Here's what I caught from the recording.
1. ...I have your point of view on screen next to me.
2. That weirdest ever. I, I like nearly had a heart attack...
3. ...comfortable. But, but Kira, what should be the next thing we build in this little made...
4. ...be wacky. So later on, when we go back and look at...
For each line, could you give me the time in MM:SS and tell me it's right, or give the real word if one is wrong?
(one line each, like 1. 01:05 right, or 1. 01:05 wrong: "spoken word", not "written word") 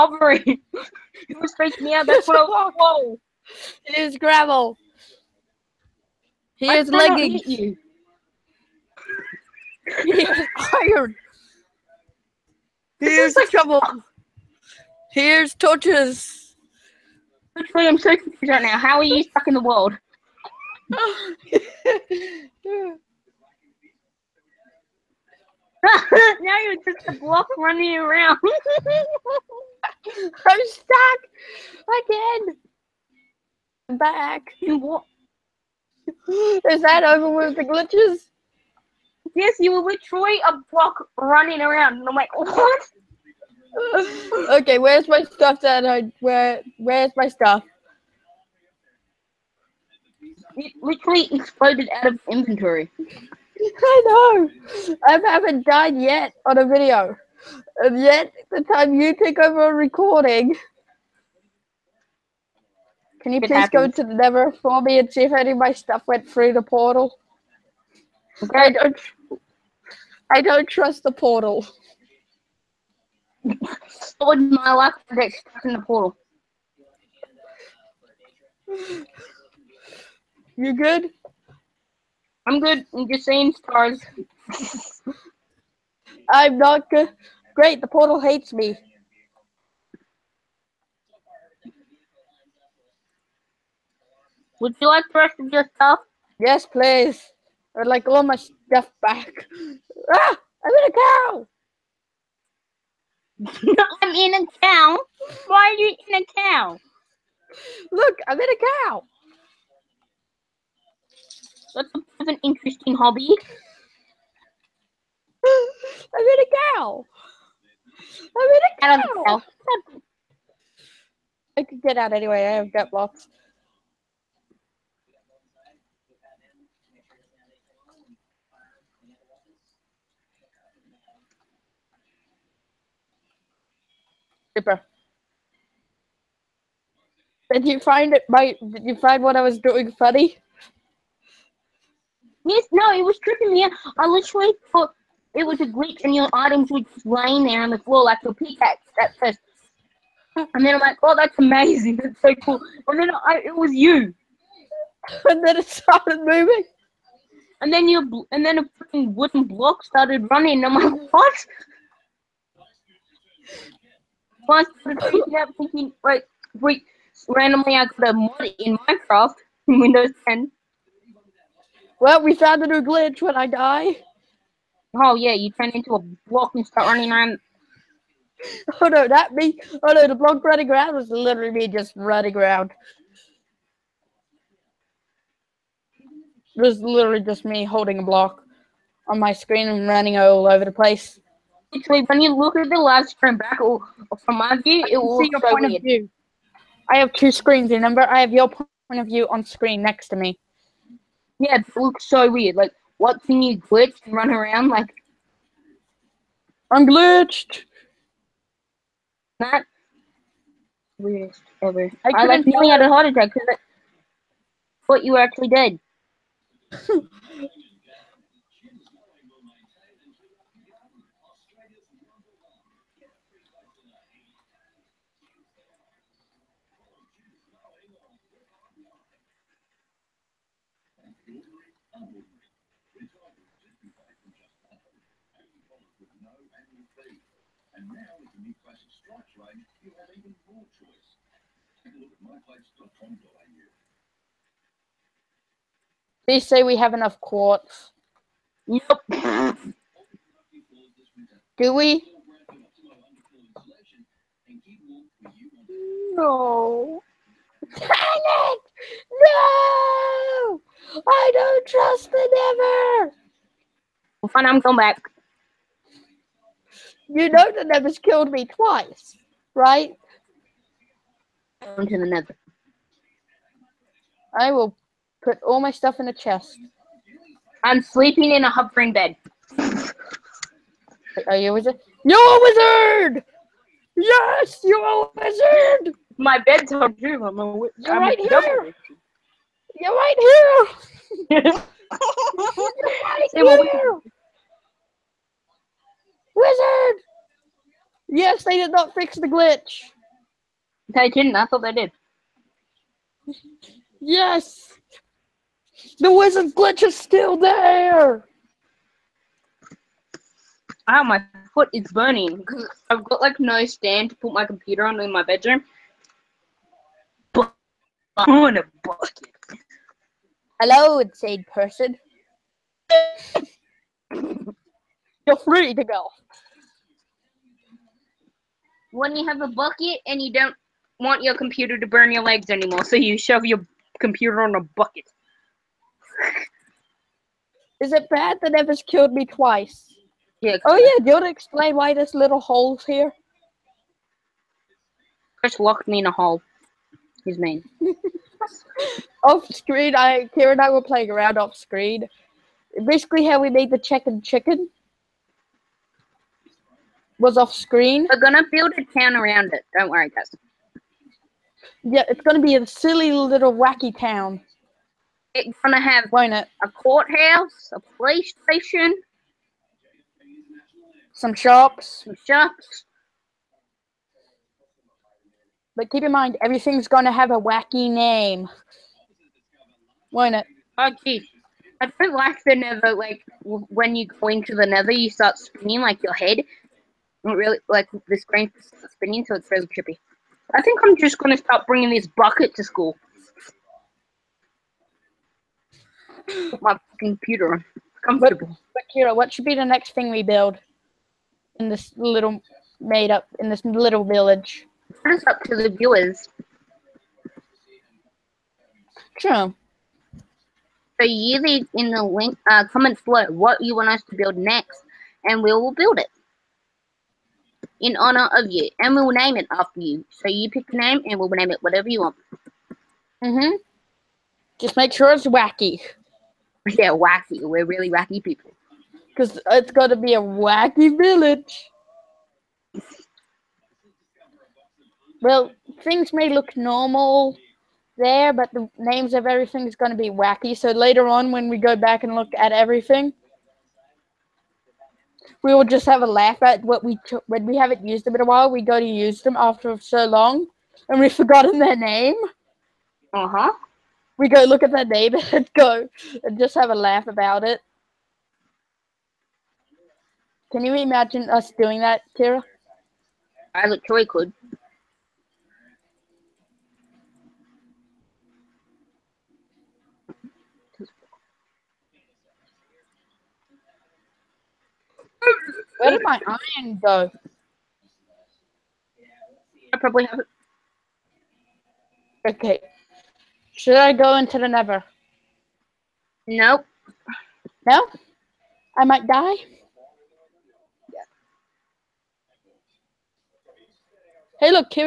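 1. 03:18 right
2. 03:29 right
3. 06:38 right
4. 07:19 right.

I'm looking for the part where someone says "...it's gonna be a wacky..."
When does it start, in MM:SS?
07:09.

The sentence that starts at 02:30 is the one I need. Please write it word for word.
And then I'm like, oh, that's amazing.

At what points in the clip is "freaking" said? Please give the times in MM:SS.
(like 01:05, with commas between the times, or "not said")
00:01, 02:38.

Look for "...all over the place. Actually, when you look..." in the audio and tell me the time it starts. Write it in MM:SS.
03:10.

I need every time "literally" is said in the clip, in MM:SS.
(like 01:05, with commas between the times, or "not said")
00:39, 00:50, 02:24, 03:01, 03:06, 07:43.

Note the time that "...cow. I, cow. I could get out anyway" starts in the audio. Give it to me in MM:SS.
01:58.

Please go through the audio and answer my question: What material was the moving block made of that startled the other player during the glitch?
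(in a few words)
wooden.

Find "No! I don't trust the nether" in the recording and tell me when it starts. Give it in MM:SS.
04:19.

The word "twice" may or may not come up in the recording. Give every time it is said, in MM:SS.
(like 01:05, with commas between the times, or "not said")
04:28, 05:39.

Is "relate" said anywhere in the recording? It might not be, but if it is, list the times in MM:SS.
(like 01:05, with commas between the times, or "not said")
not said.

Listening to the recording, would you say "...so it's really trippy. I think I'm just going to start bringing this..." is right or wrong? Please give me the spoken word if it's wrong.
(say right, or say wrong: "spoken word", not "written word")
right.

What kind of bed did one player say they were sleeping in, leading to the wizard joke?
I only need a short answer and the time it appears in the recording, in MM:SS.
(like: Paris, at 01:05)
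a hovering bed, at 04:38.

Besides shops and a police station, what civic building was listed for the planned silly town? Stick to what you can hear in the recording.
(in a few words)
a courthouse.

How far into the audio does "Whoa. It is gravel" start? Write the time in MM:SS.
00:02.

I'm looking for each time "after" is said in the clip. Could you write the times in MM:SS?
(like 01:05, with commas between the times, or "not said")
06:59, 07:29.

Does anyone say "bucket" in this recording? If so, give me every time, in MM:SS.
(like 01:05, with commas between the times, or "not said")
05:18, 05:29, 05:34, 06:32.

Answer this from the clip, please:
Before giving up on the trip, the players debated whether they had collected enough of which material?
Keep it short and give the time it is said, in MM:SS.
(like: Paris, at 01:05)
quartz, at 04:07.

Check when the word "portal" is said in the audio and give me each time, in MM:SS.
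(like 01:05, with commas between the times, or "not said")
01:06, 01:11, 01:15, 01:27.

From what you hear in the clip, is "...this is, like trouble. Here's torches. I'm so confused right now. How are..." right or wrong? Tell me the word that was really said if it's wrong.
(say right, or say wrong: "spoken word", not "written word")
right.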